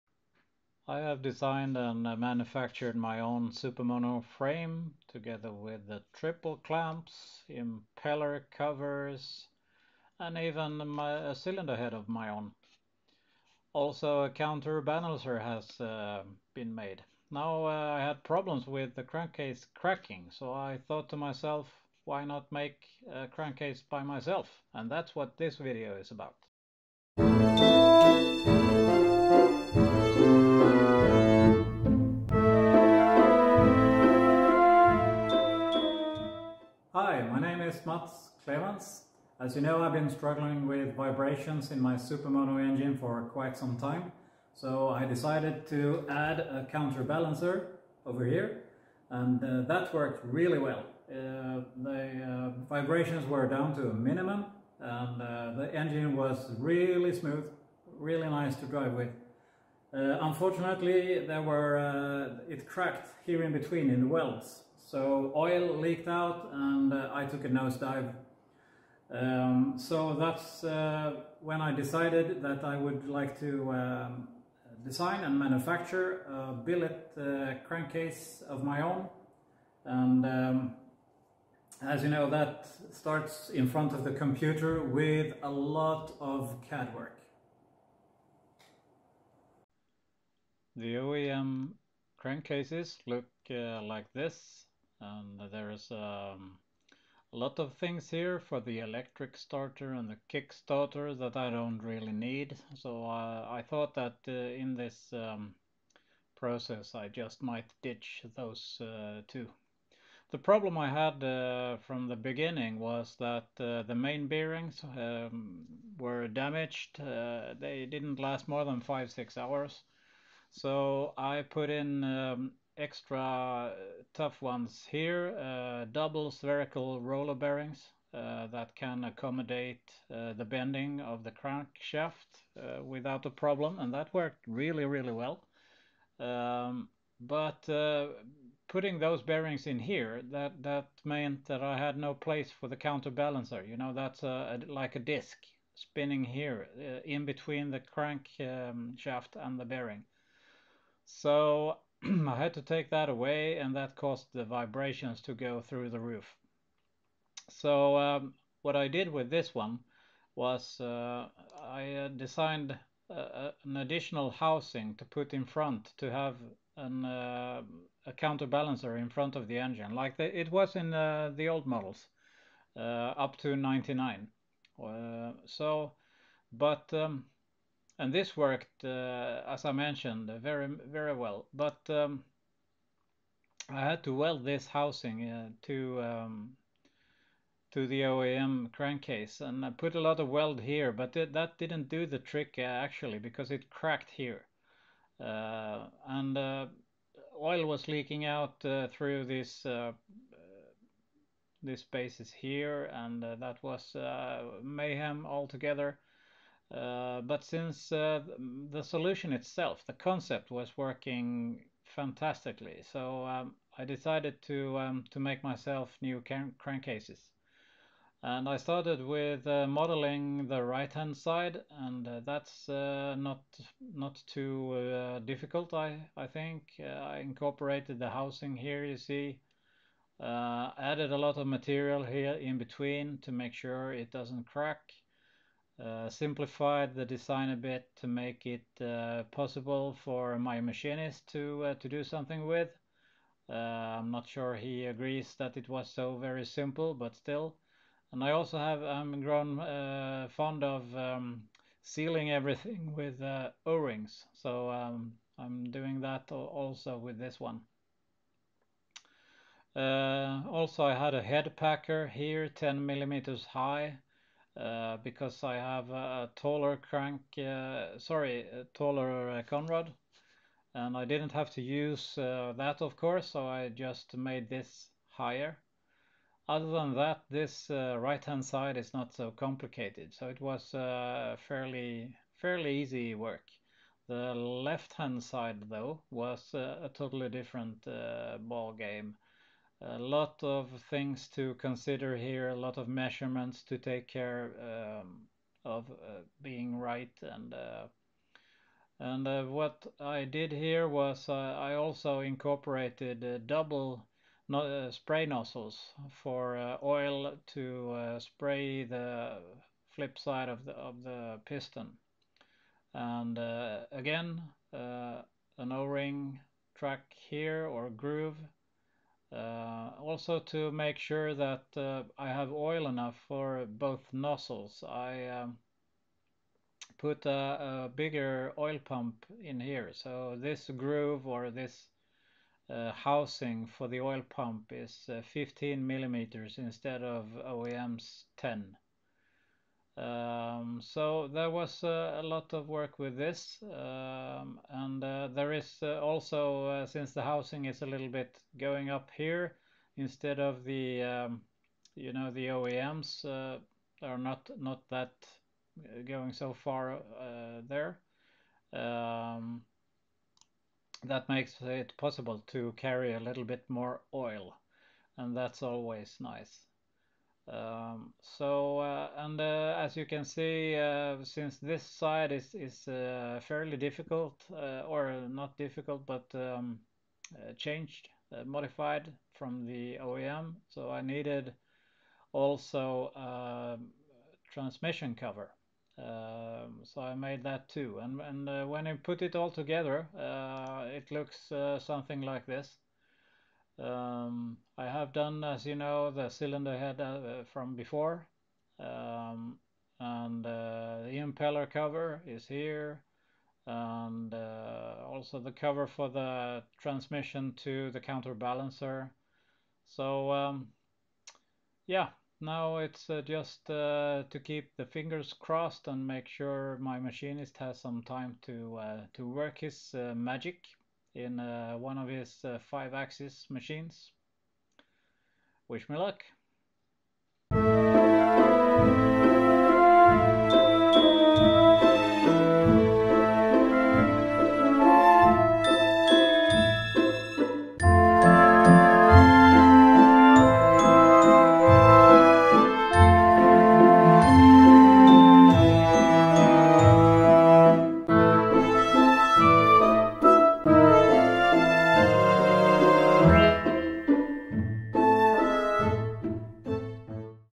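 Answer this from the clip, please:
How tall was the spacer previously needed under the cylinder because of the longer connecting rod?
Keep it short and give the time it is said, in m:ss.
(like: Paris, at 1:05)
10 millimeters, at 4:22.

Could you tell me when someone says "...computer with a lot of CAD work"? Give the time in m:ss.
1:24.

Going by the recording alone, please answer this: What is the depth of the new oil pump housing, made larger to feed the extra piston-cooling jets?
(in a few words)
15 millimeters.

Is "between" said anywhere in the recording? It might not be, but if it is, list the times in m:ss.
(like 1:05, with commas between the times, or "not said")
1:03, 2:27, 3:52.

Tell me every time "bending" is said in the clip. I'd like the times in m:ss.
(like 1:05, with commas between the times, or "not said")
2:10.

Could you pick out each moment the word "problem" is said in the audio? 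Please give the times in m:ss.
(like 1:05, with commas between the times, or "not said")
0:18, 1:50, 2:13.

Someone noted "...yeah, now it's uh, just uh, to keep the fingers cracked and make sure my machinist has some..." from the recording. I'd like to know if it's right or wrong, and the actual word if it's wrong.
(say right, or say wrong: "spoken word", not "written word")
wrong: "crossed", not "cracked".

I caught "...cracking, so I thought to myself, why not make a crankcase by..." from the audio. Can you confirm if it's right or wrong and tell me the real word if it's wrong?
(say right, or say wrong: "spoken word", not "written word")
right.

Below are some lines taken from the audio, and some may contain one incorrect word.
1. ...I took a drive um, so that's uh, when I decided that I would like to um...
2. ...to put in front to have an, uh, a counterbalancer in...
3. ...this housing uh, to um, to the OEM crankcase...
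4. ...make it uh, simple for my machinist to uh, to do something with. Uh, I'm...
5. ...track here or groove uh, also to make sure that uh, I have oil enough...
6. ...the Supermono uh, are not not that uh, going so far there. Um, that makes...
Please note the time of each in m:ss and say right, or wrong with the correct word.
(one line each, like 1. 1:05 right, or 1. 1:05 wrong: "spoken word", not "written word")
1. 1:06 wrong: "nosedive", not "drive"
2. 2:44 right
3. 3:04 right
4. 3:58 wrong: "possible", not "simple"
5. 5:16 right
6. 5:52 wrong: "OEMs", not "Supermono".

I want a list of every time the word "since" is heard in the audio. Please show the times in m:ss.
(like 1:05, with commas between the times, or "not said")
3:27, 5:46, 6:11.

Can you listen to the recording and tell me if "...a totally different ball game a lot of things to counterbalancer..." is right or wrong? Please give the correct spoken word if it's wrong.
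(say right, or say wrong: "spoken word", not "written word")
wrong: "consider", not "counterbalancer".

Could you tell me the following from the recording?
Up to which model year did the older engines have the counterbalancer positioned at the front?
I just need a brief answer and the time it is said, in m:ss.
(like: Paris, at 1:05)
99, at 2:53.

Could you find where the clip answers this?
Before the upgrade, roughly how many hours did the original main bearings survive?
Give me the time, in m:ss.
1:58.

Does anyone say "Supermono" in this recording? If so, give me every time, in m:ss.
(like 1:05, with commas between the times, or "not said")
0:03, 0:41.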